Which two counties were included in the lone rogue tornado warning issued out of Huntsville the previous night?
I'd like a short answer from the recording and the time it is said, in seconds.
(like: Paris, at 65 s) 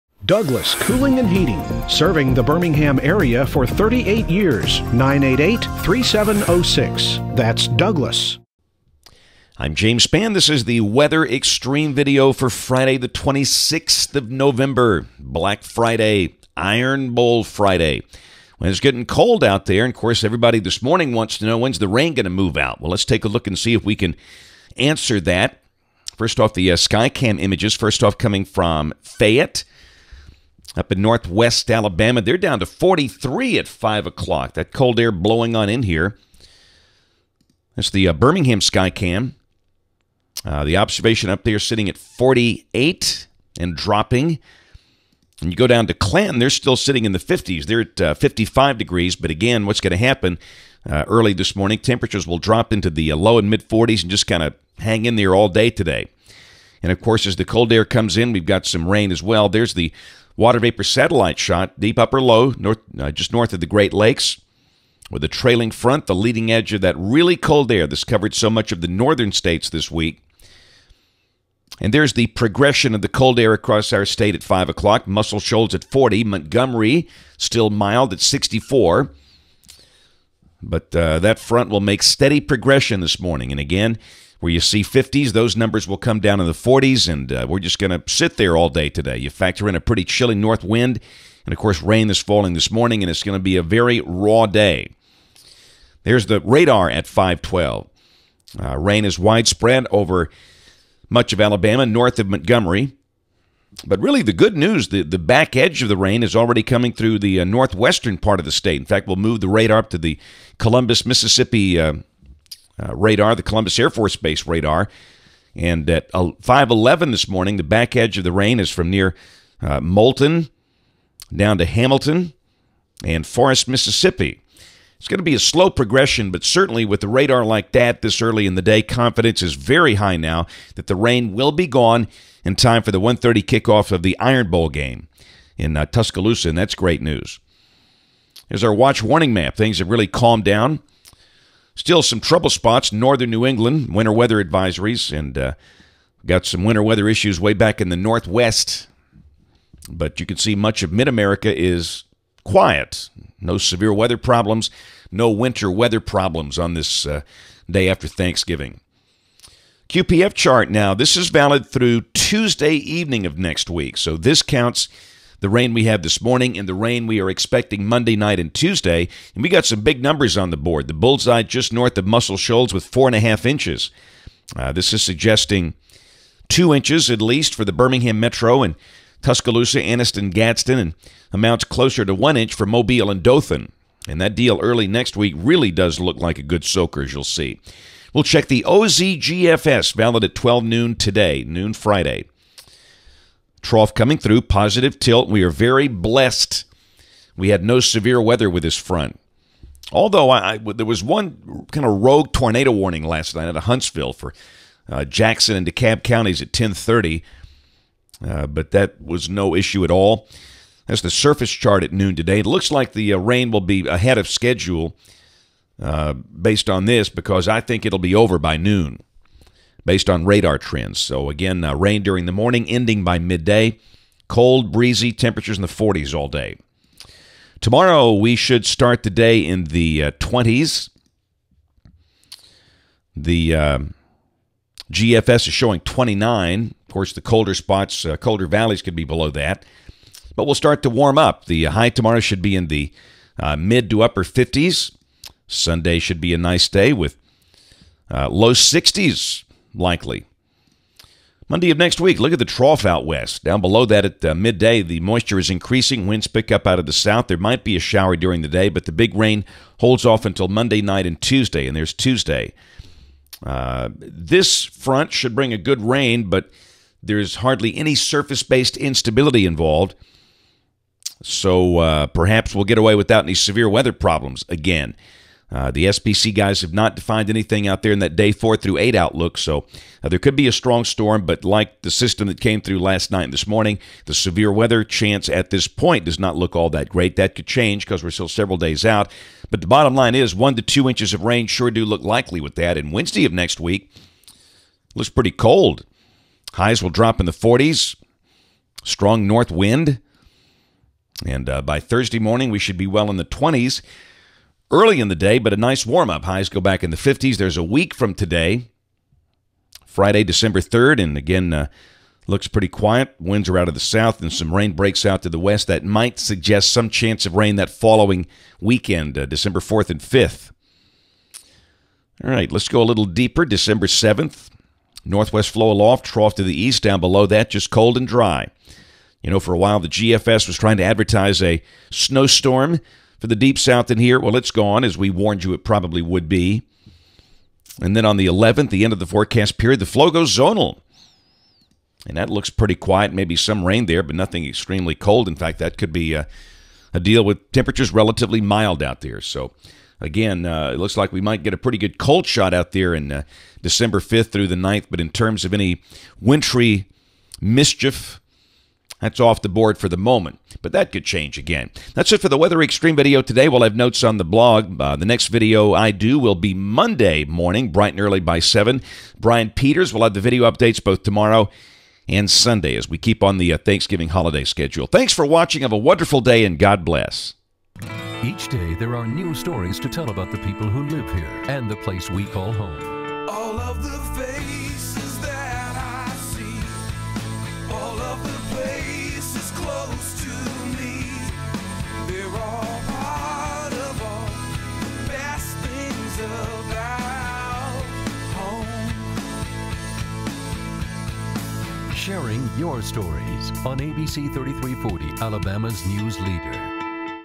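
Jackson and DeKalb, at 205 s.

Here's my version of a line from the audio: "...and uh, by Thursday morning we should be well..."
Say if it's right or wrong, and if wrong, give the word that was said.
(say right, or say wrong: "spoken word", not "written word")
right.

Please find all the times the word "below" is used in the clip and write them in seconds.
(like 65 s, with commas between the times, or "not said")
239 s, 253 s, 326 s.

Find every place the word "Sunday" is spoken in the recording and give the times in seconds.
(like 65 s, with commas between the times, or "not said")
245 s, 372 s.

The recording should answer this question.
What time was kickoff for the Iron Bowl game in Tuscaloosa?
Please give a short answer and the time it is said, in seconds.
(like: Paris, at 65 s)
1:30, at 133 s.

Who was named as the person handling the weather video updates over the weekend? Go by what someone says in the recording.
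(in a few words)
Brian Peters.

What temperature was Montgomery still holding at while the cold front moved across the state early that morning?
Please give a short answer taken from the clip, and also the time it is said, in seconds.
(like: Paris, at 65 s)
64, at 78 s.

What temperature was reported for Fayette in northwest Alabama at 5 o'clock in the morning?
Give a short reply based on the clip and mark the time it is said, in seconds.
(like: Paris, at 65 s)
43, at 32 s.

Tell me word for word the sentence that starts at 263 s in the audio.
Uh, this front should bring a good rain, but there's hardly any surface based instability involved.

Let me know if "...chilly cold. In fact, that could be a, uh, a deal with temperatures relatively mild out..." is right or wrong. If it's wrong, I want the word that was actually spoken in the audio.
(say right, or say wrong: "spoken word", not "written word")
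wrong: "extremely", not "chilly".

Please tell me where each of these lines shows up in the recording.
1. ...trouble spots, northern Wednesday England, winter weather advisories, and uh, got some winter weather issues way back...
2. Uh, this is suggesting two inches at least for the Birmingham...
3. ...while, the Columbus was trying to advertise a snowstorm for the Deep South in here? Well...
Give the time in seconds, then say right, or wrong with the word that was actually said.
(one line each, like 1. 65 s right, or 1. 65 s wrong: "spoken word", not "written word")
1. 142 s wrong: "New", not "Wednesday"
2. 174 s right
3. 329 s wrong: "GFS", not "Columbus".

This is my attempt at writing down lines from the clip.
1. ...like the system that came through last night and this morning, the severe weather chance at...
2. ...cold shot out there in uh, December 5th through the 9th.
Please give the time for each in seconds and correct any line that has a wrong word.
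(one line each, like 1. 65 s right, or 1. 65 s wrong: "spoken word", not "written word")
1. 281 s right
2. 351 s right.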